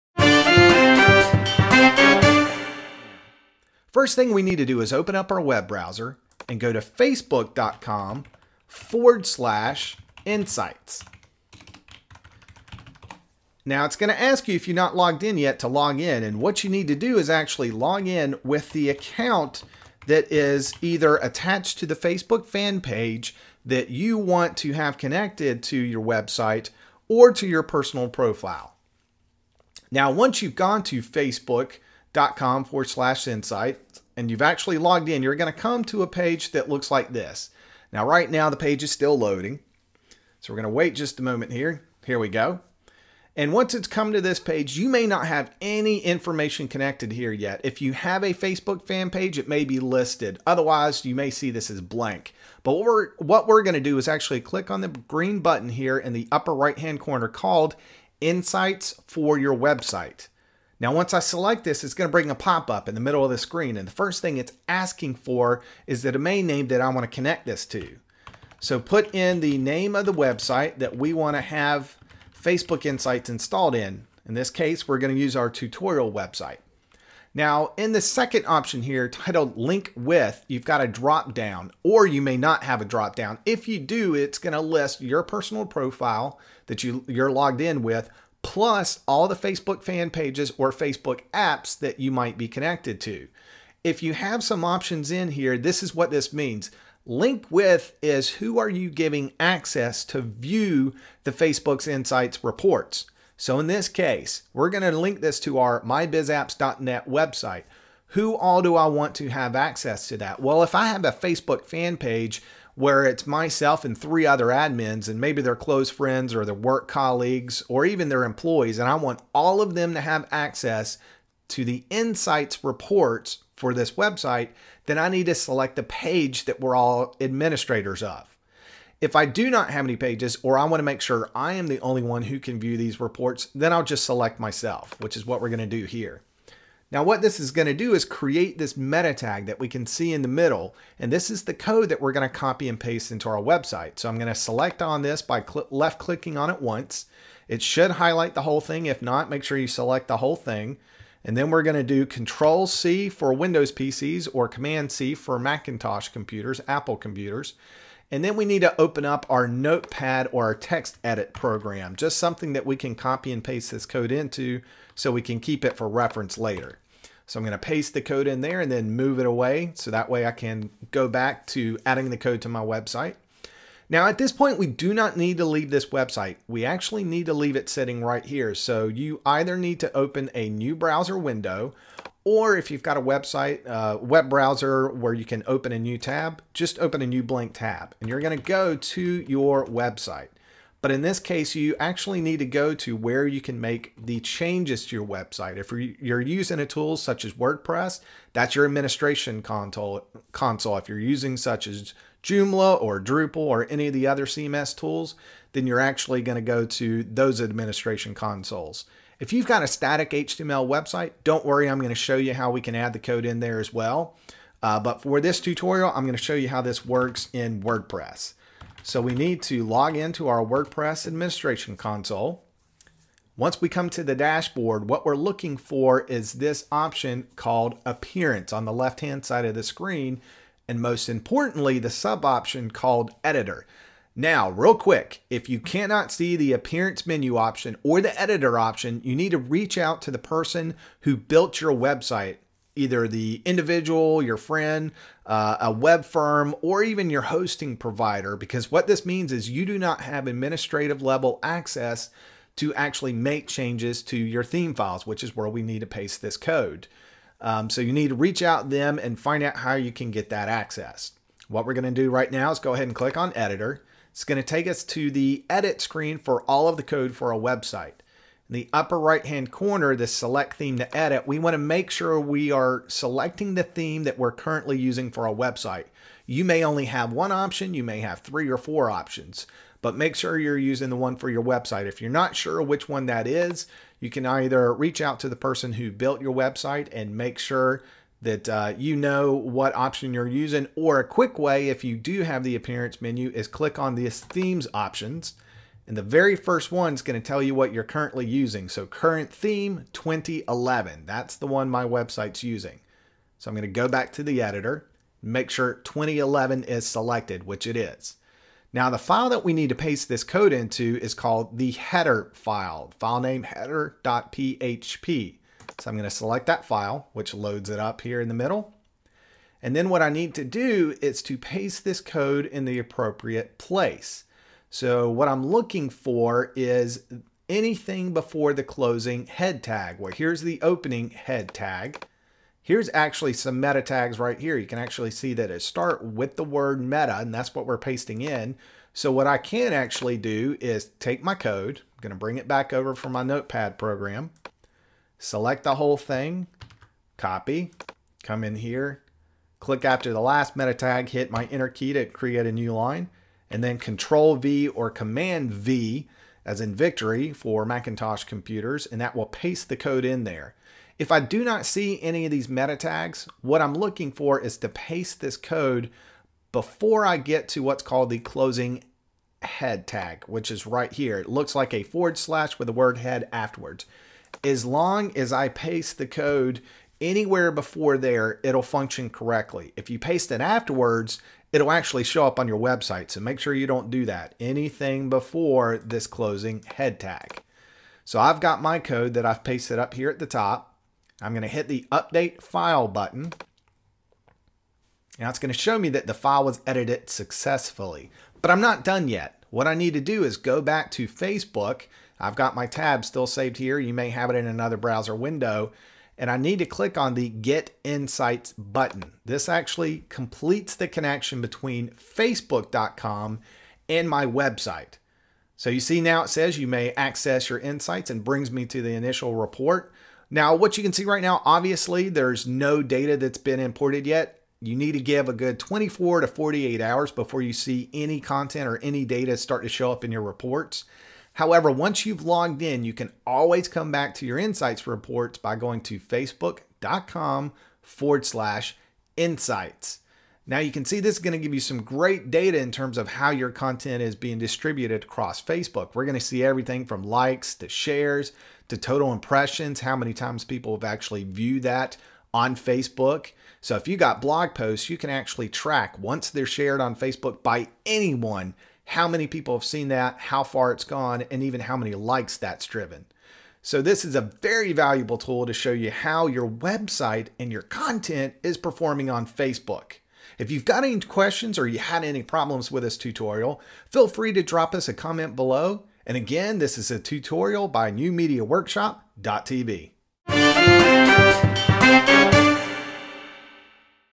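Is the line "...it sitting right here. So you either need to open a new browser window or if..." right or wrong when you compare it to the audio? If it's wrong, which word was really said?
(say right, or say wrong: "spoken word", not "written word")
right.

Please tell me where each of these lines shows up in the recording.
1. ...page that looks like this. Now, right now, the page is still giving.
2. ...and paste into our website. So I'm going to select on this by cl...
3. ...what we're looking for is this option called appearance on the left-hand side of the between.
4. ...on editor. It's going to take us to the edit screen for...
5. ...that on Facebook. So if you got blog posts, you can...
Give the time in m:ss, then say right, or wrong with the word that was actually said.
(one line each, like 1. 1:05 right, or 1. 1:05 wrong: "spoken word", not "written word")
1. 0:36 wrong: "loading", not "giving"
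2. 2:22 right
3. 3:44 wrong: "screen", not "between"
4. 4:23 right
5. 7:31 right.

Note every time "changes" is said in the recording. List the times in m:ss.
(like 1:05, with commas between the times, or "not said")
3:14, 4:13.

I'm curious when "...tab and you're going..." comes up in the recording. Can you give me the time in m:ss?
3:07.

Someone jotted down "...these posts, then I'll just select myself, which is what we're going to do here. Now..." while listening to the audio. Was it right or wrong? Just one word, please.
wrong.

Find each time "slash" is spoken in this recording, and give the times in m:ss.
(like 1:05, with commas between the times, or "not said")
0:09, 0:32, 6:12, 7:18.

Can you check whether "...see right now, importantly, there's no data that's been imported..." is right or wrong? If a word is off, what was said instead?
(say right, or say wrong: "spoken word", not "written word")
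wrong: "obviously", not "importantly".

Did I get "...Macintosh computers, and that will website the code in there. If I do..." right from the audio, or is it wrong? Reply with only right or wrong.
wrong.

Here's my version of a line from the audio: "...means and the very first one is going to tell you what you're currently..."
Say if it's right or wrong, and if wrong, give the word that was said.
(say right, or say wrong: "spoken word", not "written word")
wrong: "options", not "means".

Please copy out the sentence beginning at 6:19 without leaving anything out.
If you paste it afterwards, it'll actually show up on your website.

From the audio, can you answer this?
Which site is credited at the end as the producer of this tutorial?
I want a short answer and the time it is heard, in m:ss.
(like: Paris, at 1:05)
newmediaworkshop.tv, at 7:57.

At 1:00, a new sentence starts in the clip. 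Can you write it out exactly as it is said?
Now, once I select this, it's going to bring a pop-up in the middle of the screen.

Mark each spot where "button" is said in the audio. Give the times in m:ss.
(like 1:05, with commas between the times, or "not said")
0:55, 6:32, 6:48.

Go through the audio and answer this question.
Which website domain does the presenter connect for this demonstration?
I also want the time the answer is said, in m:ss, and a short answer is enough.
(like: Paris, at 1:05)
mybizapps.net, at 1:45.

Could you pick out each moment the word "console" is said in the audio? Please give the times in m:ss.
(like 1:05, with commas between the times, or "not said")
3:19, 3:28, 3:41.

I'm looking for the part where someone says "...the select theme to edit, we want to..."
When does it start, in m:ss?
4:29.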